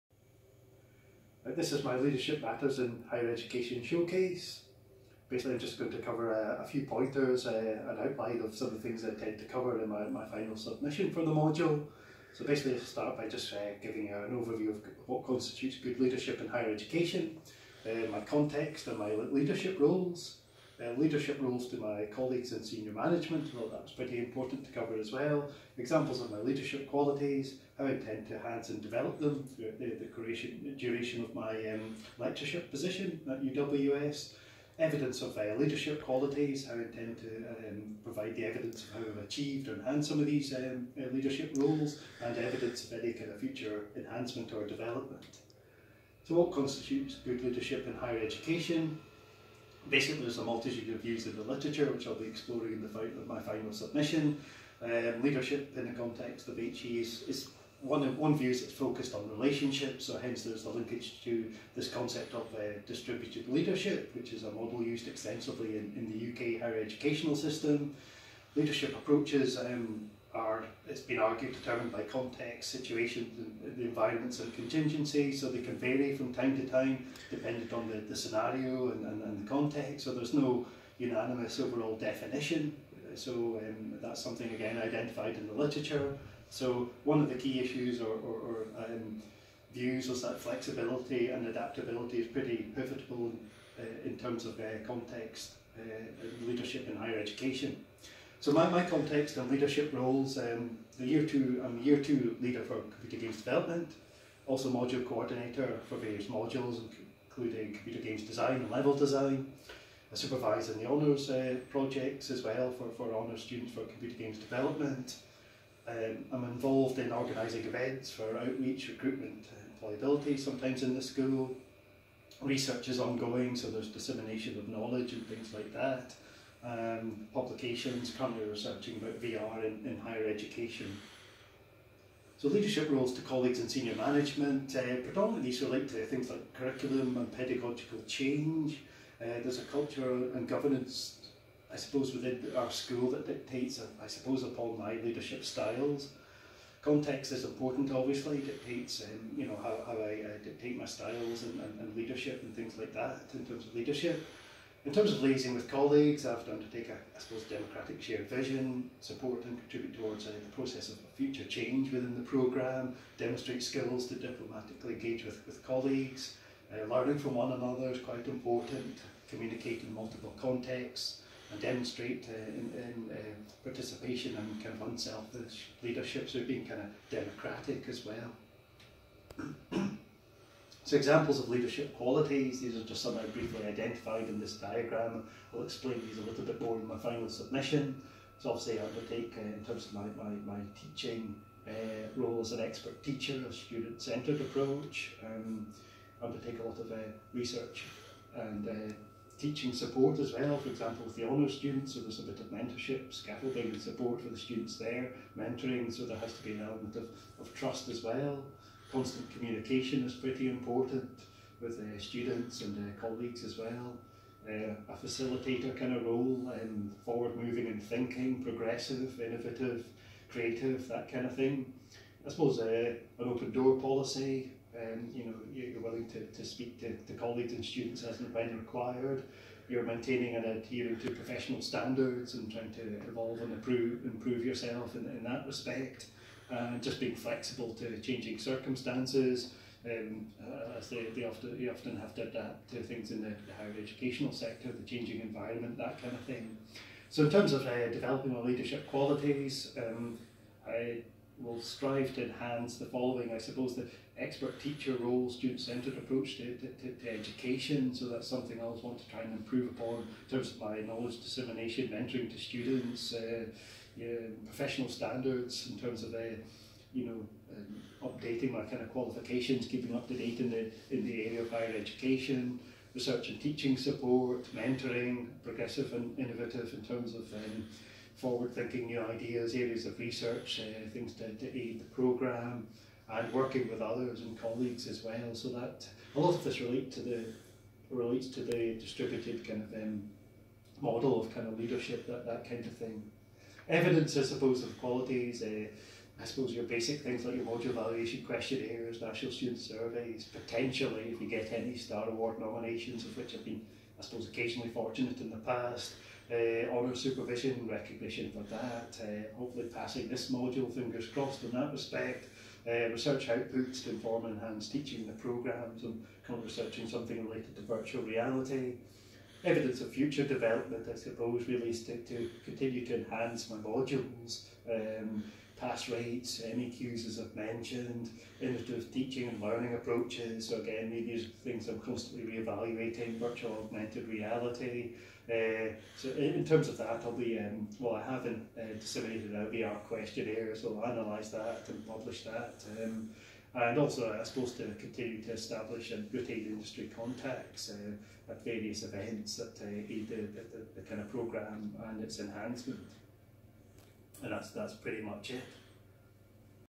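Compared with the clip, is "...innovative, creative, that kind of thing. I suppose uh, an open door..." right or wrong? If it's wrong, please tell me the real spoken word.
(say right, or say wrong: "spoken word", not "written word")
right.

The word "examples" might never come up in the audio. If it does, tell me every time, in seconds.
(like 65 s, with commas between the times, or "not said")
25 s, 180 s, 200 s.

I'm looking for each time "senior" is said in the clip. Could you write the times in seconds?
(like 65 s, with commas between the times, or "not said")
22 s, 133 s.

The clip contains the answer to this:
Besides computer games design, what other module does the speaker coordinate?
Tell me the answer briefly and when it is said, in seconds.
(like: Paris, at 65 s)
level design, at 108 s.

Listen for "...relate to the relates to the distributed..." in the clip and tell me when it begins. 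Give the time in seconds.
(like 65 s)
286 s.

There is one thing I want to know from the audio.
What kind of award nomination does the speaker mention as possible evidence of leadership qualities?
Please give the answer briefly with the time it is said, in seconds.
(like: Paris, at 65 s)
Star Award, at 301 s.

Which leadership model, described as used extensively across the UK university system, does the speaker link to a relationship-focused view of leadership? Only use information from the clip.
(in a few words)
distributed leadership.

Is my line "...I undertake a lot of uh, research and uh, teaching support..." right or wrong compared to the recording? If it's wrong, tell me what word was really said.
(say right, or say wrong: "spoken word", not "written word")
right.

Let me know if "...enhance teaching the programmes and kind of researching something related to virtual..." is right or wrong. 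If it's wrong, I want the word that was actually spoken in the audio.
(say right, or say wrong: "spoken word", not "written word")
right.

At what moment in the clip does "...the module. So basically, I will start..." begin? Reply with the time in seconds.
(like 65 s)
11 s.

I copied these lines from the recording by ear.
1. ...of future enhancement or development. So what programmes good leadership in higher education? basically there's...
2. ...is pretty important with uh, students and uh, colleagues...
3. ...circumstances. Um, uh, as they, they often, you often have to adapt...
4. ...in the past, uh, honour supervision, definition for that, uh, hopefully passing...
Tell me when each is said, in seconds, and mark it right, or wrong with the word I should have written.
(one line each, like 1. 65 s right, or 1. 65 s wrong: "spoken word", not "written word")
1. 43 s wrong: "constitutes", not "programmes"
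2. 210 s right
3. 238 s right
4. 305 s wrong: "recognition", not "definition".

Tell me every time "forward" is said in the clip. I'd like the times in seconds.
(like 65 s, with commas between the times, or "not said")
217 s, 278 s.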